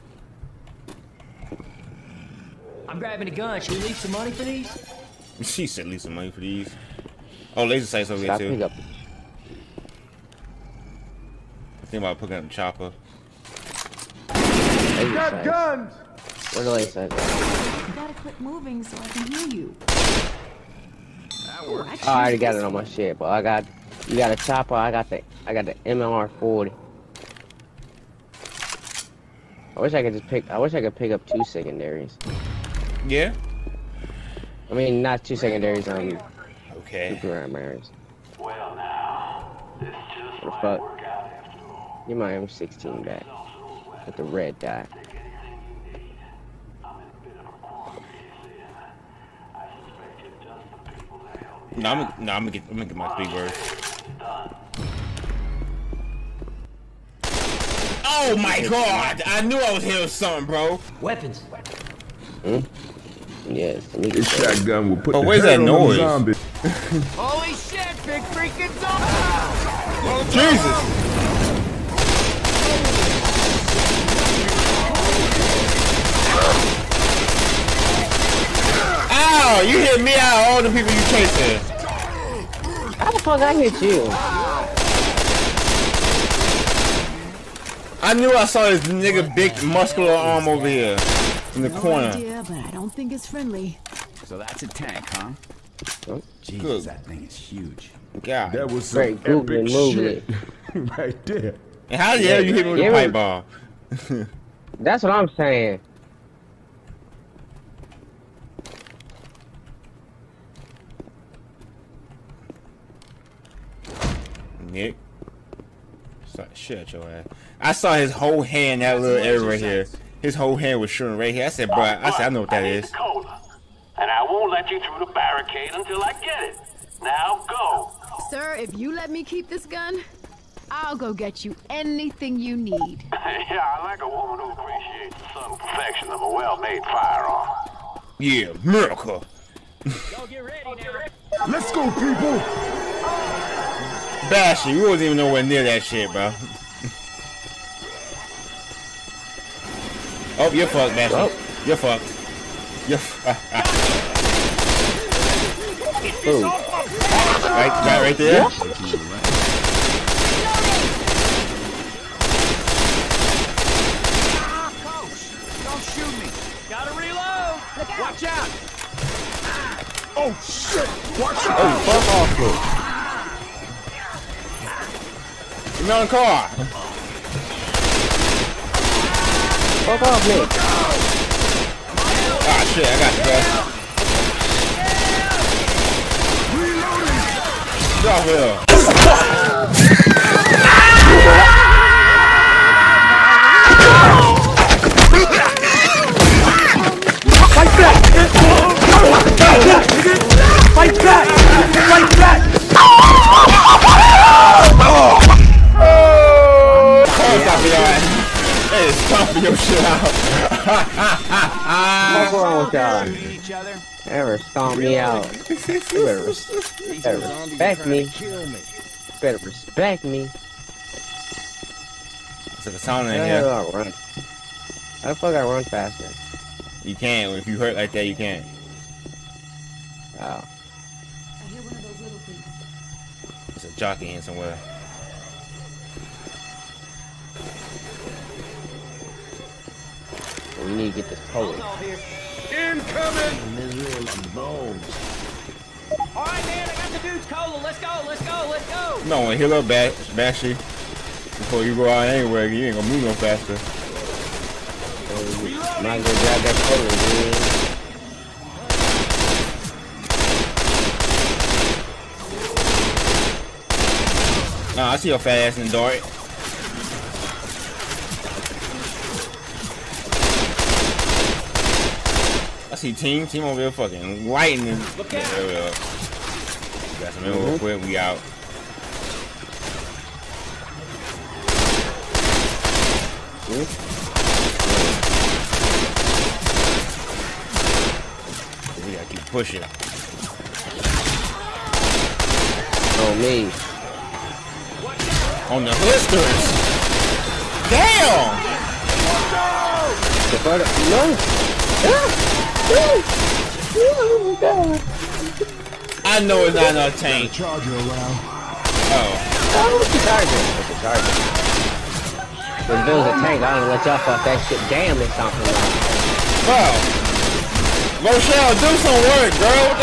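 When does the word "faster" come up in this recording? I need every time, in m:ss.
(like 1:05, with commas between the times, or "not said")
3:45, 4:13.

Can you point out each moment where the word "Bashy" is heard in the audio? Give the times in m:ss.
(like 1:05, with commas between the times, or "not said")
2:24, 4:09.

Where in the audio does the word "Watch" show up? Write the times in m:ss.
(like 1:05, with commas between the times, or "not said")
2:38, 2:51.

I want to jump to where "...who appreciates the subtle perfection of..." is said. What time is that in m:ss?
2:14.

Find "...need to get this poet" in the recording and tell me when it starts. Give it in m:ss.
4:00.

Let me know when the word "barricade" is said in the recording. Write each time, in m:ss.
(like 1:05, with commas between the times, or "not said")
2:05.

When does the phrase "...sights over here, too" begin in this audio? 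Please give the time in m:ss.
0:07.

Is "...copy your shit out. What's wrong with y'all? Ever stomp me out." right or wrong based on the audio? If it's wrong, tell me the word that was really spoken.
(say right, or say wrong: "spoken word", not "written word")
right.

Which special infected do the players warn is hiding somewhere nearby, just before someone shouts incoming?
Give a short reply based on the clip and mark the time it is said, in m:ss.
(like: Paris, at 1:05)
Jockey, at 3:53.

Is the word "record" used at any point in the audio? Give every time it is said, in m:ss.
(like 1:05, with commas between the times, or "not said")
not said.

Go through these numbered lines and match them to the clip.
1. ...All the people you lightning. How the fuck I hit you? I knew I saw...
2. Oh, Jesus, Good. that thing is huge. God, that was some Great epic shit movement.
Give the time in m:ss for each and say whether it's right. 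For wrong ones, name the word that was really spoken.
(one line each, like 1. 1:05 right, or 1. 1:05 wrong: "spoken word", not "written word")
1. 1:20 wrong: "chasing", not "lightning"
2. 1:36 right.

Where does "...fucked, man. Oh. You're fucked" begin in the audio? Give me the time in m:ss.
2:30.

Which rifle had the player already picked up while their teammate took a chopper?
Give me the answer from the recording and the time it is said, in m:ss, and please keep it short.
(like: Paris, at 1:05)
MLR 40, at 0:25.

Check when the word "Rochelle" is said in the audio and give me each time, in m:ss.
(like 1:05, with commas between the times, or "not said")
5:18.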